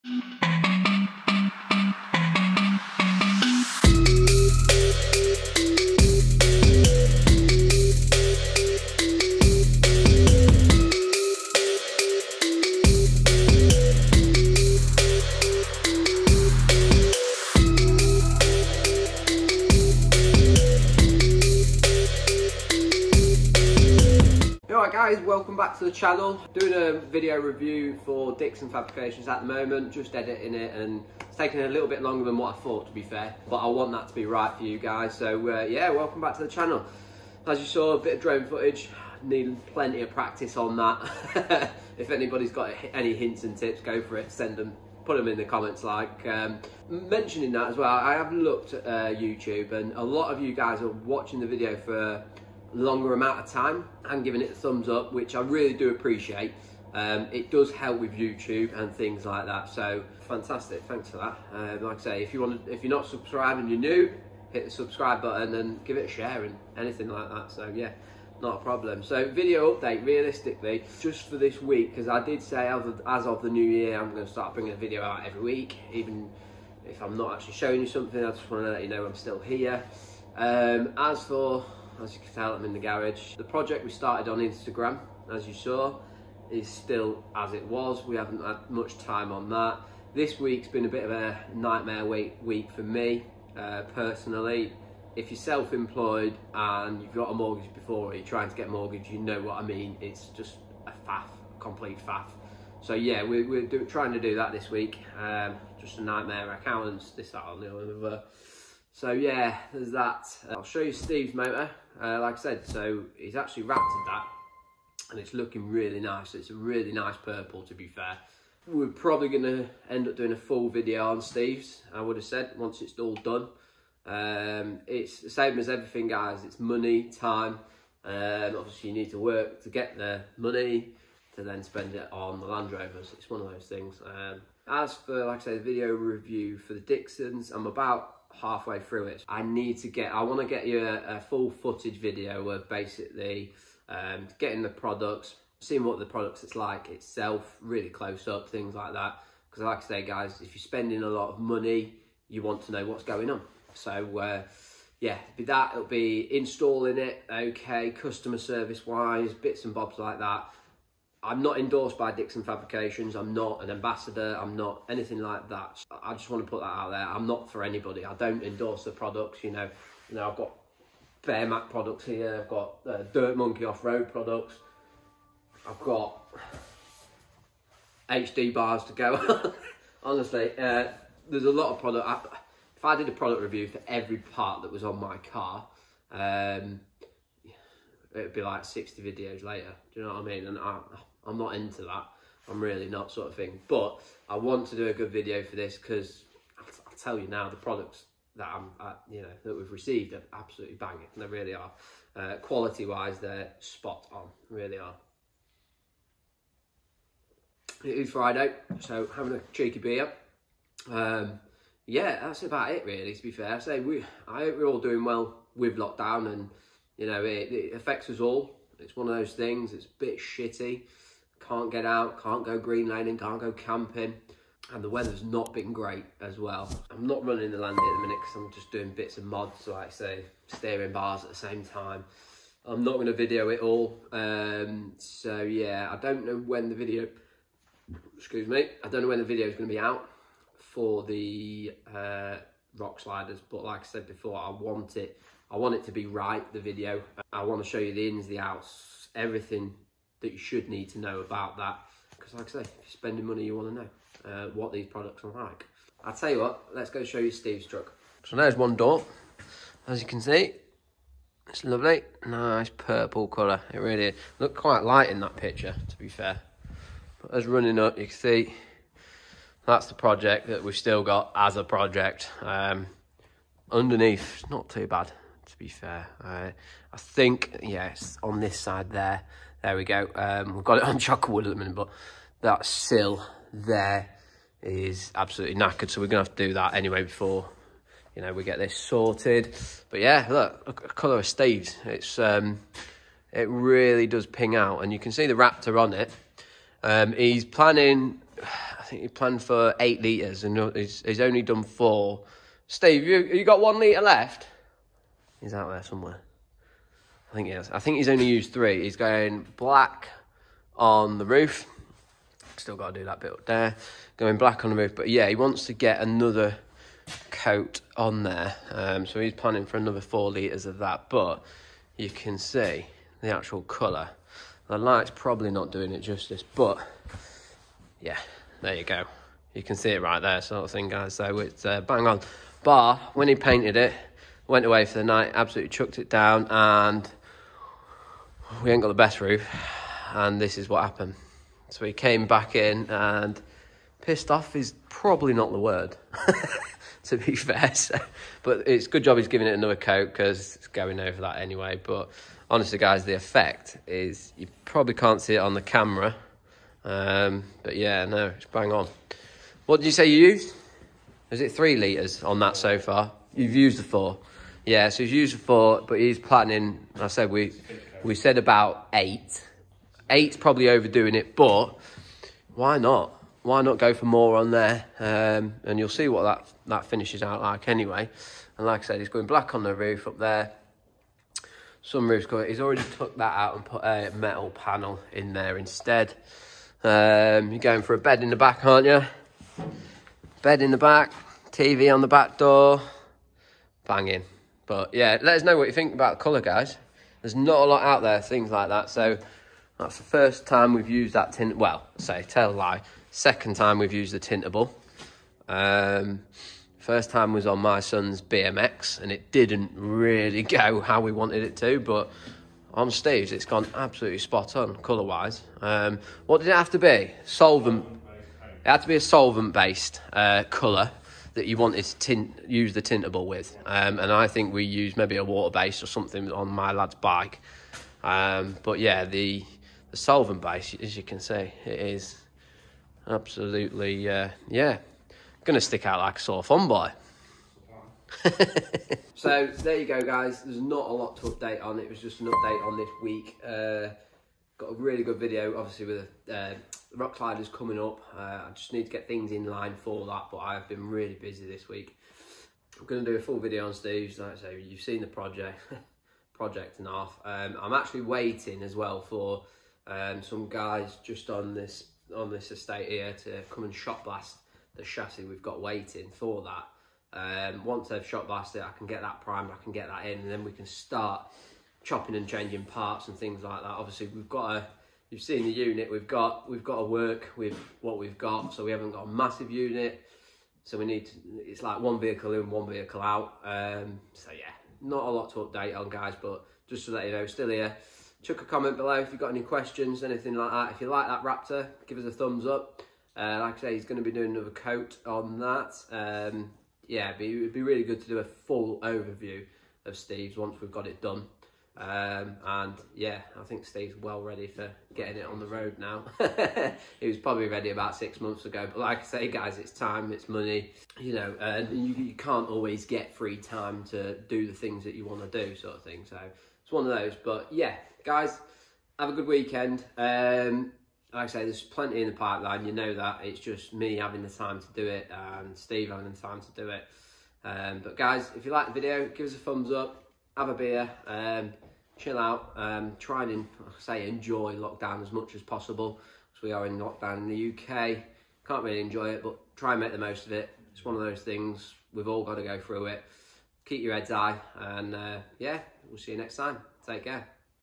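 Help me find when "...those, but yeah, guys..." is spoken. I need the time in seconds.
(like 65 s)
516 s.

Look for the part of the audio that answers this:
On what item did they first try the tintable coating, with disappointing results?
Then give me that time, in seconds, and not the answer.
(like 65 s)
407 s.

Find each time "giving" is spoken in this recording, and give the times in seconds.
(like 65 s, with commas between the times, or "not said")
54 s, 349 s.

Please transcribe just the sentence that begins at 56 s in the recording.
Um, it does help with YouTube and things like that.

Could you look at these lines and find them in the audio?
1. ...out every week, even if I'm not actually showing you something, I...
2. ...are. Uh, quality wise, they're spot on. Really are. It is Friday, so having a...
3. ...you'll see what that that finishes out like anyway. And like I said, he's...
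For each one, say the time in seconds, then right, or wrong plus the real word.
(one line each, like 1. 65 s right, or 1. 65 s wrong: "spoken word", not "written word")
1. 75 s right
2. 201 s right
3. 375 s right.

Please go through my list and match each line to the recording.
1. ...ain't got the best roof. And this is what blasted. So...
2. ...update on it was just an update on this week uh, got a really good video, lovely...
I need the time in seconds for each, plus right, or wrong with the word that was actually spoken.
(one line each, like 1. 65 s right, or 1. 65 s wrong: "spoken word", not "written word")
1. 338 s wrong: "happened", not "blasted"
2. 441 s wrong: "obviously", not "lovely".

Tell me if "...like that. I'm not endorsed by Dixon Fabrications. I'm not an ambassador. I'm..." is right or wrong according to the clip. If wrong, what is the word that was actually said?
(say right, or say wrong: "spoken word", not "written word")
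right.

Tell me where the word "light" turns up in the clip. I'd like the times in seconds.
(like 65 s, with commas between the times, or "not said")
264 s, 324 s.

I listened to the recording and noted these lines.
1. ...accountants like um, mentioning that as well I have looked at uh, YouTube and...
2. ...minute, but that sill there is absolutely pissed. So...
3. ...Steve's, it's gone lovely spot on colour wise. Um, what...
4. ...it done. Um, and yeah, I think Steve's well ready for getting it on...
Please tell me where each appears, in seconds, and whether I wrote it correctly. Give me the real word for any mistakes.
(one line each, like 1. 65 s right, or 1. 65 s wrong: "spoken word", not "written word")
1. 45 s wrong: "comments", not "accountants"
2. 281 s wrong: "knackered", not "pissed"
3. 412 s wrong: "absolutely", not "lovely"
4. 500 s right.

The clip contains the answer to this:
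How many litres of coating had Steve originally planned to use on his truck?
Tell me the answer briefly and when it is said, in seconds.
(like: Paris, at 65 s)
8, at 299 s.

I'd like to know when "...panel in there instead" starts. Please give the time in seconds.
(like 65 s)
384 s.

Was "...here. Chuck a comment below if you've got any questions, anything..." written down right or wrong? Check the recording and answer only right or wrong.
right.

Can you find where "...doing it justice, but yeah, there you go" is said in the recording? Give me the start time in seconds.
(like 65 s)
325 s.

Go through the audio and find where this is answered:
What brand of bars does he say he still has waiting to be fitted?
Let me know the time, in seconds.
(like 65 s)
178 s.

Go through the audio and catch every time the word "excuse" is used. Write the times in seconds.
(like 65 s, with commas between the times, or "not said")
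238 s.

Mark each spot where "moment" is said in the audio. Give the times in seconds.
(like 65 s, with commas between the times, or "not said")
29 s.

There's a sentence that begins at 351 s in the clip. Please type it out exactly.
But honestly, guys, the effect is you probably can't see it on the camera.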